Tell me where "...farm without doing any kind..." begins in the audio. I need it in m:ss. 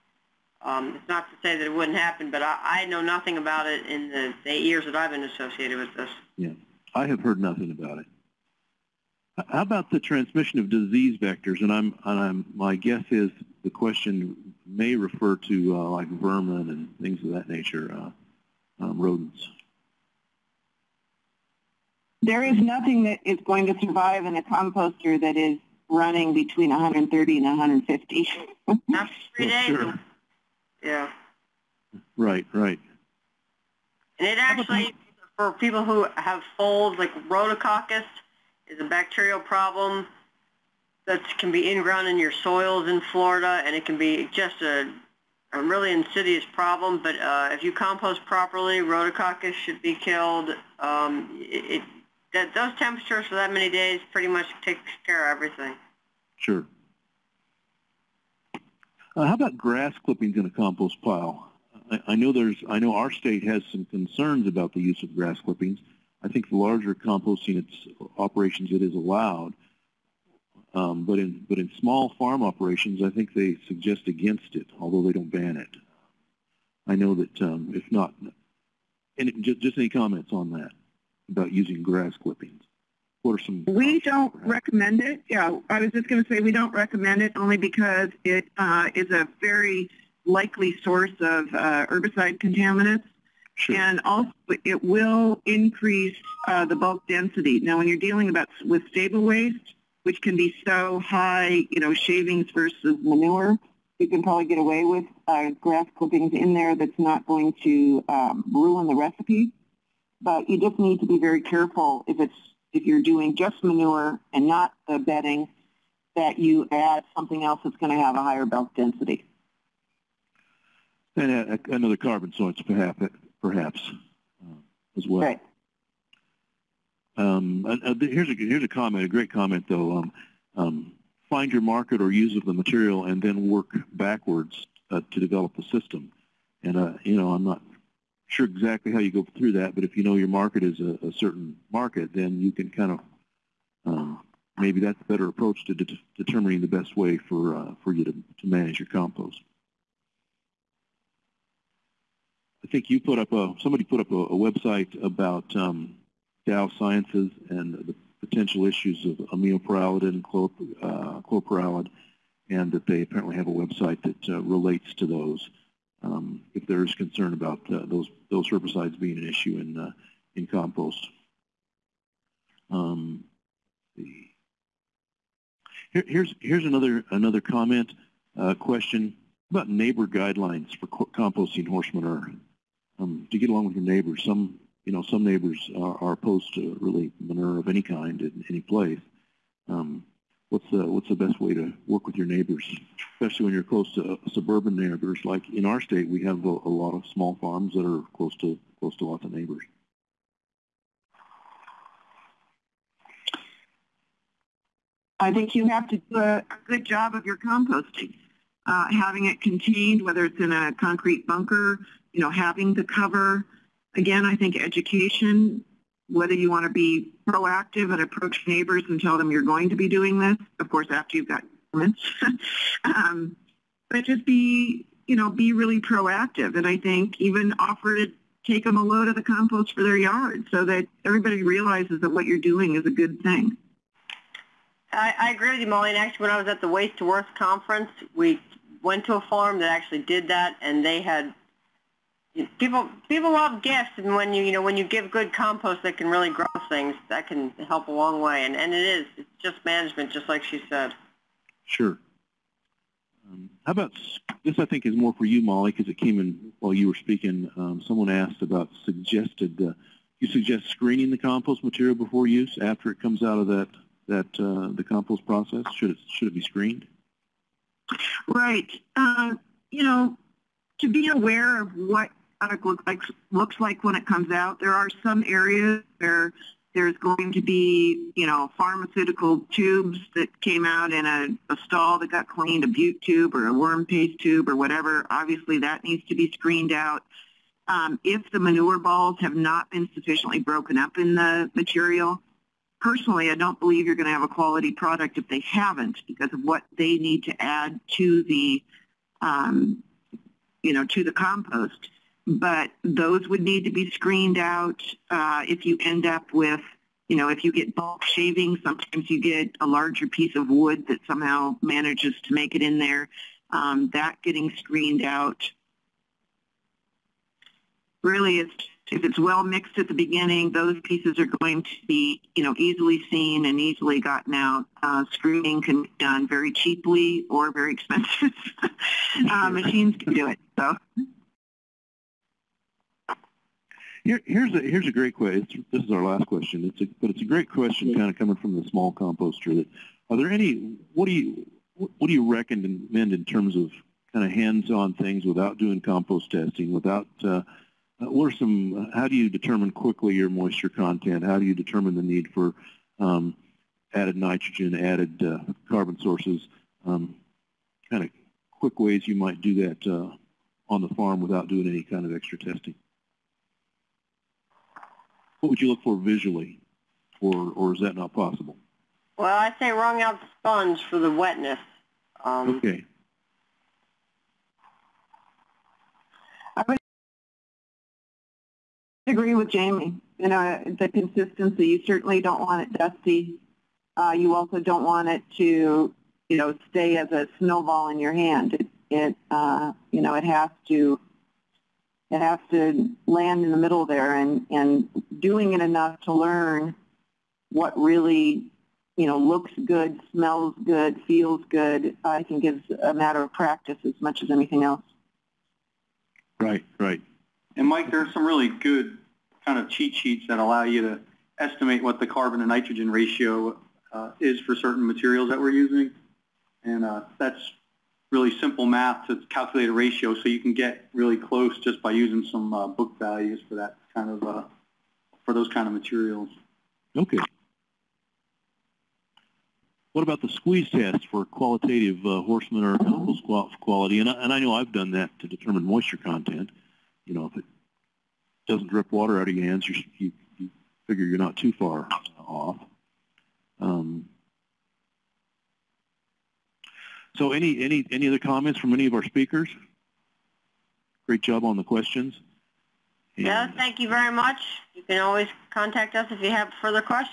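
6:00.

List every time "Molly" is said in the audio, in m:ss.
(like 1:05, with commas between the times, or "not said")
3:55, 4:15.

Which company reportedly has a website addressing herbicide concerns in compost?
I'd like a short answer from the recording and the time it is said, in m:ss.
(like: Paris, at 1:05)
Dow Sciences, at 2:36.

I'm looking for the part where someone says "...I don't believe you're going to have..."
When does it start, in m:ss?
4:53.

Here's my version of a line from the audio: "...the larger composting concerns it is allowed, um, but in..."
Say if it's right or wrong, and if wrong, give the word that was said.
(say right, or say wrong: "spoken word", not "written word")
wrong: "operations", not "concerns".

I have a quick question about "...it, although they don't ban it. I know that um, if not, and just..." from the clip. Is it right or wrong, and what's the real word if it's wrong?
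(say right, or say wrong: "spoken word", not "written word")
right.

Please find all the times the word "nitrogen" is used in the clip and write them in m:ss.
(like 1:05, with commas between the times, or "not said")
5:54, 6:52.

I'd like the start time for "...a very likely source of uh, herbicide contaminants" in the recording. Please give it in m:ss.
1:29.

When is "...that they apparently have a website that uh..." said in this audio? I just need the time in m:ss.
2:42.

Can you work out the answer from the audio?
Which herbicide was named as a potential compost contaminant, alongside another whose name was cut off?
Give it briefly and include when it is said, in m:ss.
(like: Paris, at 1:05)
Aminopyralid, at 2:39.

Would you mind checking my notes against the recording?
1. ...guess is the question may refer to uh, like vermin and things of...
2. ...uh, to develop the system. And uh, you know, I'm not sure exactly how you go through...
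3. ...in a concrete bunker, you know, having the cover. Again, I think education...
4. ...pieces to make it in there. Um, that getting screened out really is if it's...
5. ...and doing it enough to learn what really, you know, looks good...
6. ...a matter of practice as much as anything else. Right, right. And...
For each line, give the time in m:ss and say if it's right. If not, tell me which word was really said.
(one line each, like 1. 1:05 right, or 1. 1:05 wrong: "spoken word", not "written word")
1. 0:12 right
2. 2:14 right
3. 3:30 right
4. 5:11 wrong: "manages", not "pieces"
5. 6:34 right
6. 6:42 right.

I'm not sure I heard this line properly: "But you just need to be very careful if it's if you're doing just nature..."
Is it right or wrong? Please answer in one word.
wrong.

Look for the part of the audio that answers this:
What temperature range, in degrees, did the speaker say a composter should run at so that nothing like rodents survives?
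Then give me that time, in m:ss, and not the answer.
0:26.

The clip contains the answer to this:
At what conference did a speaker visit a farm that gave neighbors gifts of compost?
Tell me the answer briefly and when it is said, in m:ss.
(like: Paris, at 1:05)
Waste to Worth, at 3:56.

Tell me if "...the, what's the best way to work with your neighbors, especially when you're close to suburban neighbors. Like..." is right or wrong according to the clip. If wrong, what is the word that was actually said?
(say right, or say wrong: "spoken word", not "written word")
right.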